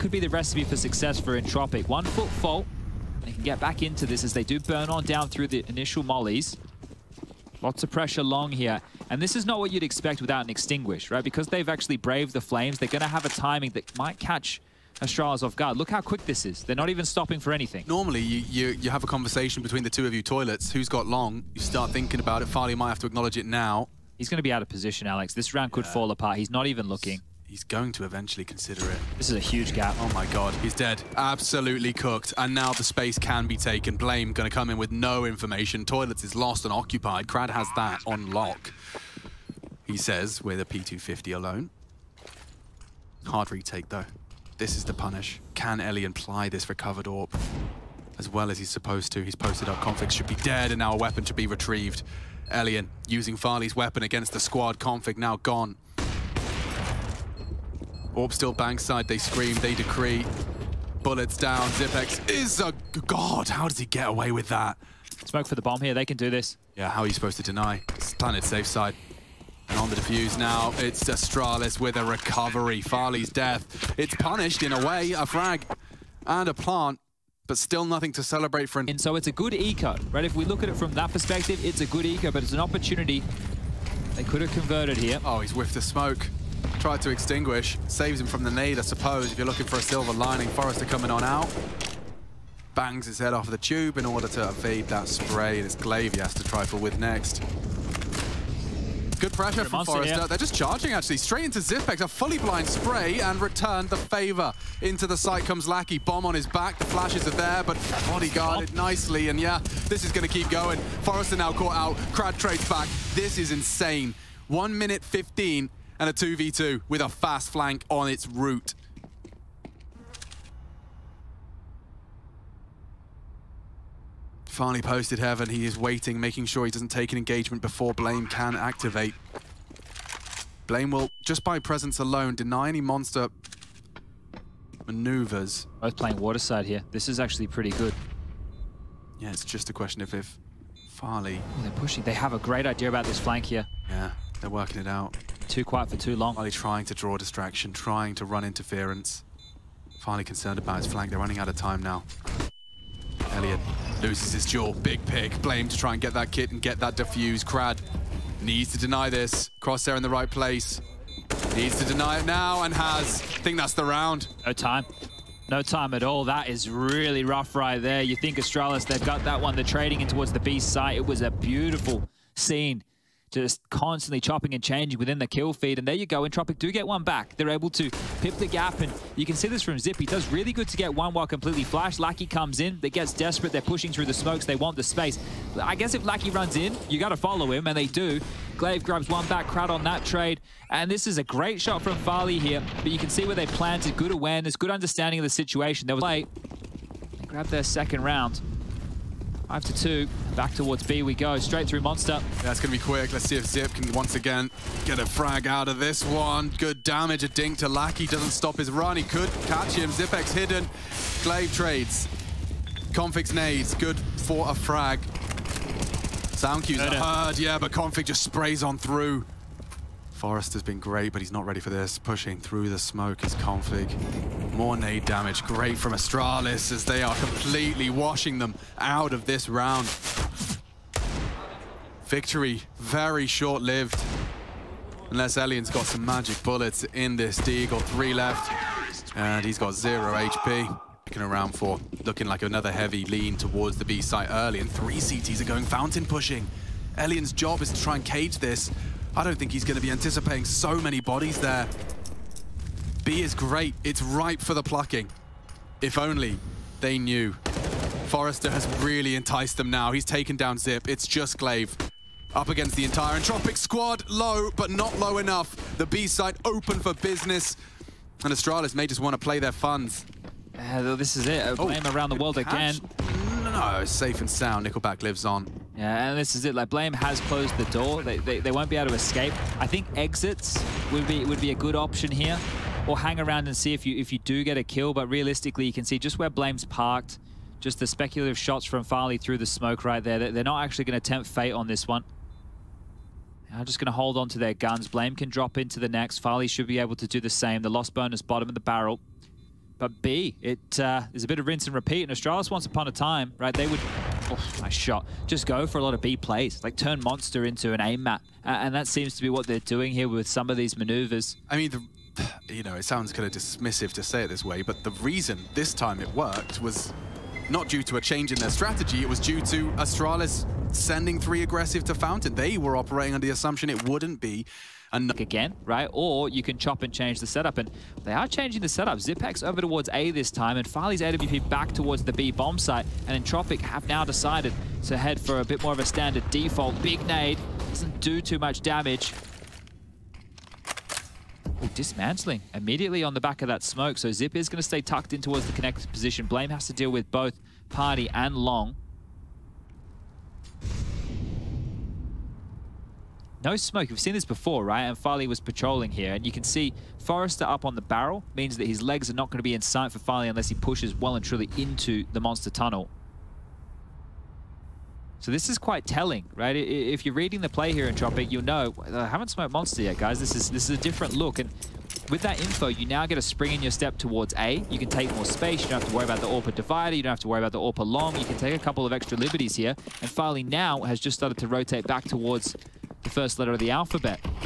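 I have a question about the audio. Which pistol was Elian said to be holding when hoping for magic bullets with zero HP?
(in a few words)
Deagle.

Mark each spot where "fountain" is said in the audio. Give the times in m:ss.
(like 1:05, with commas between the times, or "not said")
4:05, 5:21.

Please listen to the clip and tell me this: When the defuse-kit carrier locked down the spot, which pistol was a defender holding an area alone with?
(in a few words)
P250.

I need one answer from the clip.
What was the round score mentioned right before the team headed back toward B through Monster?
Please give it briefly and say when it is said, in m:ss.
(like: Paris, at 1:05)
5 to 2, at 3:19.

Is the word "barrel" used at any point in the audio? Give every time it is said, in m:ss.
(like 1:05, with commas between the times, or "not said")
4:58, 5:57.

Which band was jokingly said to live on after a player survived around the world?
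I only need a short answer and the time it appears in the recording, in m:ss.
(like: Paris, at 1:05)
Nickelback, at 4:34.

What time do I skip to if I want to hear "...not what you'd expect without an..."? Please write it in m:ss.
0:09.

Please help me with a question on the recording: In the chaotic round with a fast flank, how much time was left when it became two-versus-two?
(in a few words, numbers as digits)
1 minute 15.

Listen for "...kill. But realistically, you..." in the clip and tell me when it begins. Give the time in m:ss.
4:44.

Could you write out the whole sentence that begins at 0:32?
And now the space can be taken.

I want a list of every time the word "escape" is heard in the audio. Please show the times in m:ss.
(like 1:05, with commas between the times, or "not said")
4:38.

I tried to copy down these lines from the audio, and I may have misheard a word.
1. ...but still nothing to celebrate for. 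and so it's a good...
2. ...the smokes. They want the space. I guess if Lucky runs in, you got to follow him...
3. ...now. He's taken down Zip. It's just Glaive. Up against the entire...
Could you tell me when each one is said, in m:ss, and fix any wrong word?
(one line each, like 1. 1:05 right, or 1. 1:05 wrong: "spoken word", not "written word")
1. 1:17 right
2. 3:04 right
3. 4:19 right.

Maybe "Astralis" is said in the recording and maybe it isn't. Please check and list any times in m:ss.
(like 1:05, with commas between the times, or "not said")
0:15, 1:11, 2:48, 3:45, 4:28, 5:02, 5:19.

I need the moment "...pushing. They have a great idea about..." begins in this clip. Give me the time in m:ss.
2:21.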